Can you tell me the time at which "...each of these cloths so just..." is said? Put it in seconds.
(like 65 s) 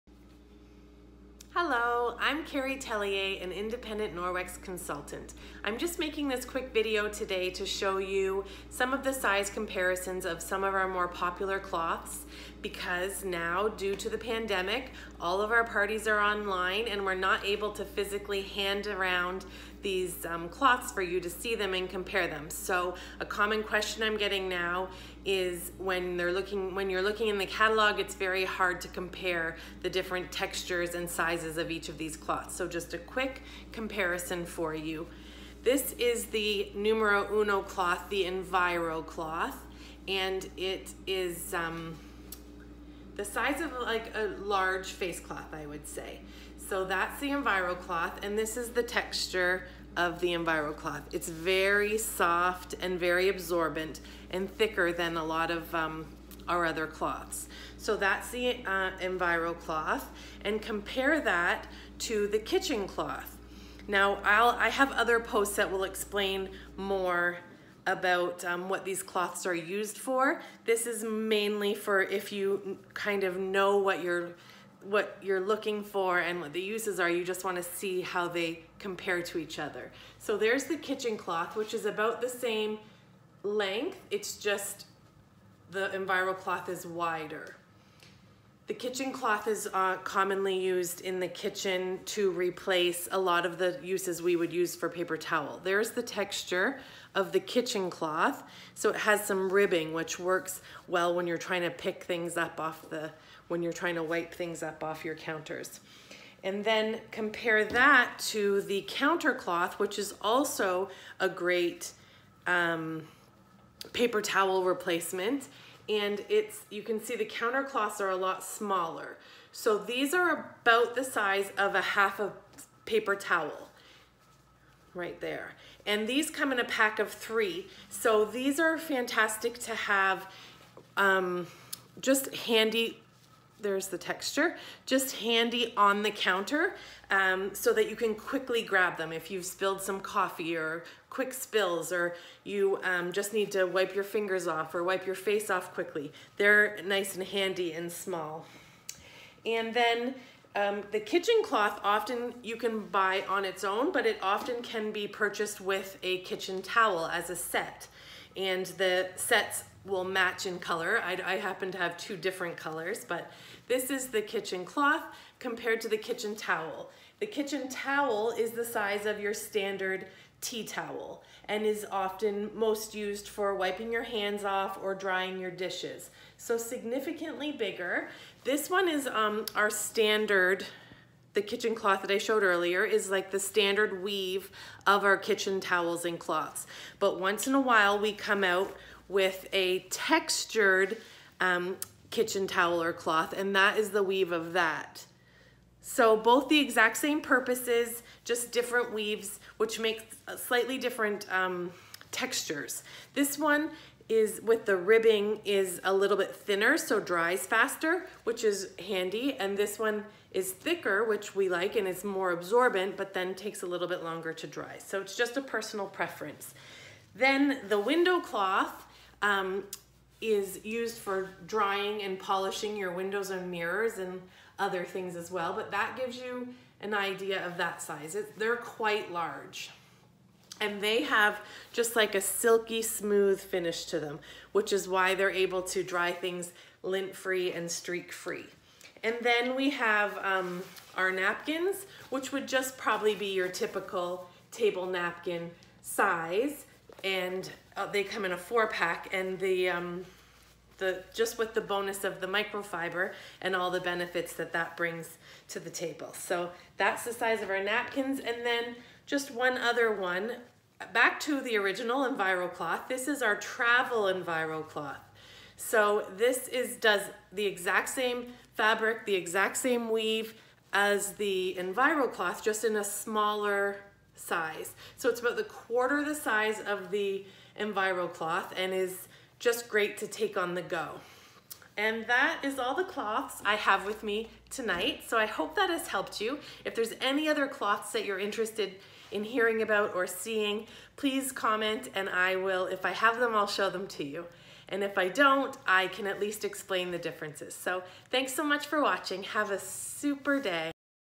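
31 s.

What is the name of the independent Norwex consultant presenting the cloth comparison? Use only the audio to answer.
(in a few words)
Carrie Tellier.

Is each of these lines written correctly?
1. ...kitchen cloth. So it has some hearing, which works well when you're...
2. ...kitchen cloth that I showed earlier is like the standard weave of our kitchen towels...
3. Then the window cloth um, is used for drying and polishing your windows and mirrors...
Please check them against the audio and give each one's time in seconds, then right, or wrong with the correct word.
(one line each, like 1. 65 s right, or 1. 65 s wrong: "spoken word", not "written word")
1. 97 s wrong: "ribbing", not "hearing"
2. 181 s right
3. 217 s right.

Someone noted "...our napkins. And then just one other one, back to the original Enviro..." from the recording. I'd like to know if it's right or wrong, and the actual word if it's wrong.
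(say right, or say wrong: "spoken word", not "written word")
right.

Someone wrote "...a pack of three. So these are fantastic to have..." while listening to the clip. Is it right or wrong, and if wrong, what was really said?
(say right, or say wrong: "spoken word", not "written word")
right.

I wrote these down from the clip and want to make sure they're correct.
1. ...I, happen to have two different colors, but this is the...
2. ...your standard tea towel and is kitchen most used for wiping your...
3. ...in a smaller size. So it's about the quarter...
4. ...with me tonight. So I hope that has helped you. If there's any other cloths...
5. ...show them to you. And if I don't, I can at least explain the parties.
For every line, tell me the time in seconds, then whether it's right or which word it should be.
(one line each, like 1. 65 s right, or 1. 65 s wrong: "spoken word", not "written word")
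1. 161 s right
2. 169 s wrong: "often", not "kitchen"
3. 272 s right
4. 283 s right
5. 293 s wrong: "differences", not "parties".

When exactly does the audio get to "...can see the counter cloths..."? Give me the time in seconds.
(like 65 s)
116 s.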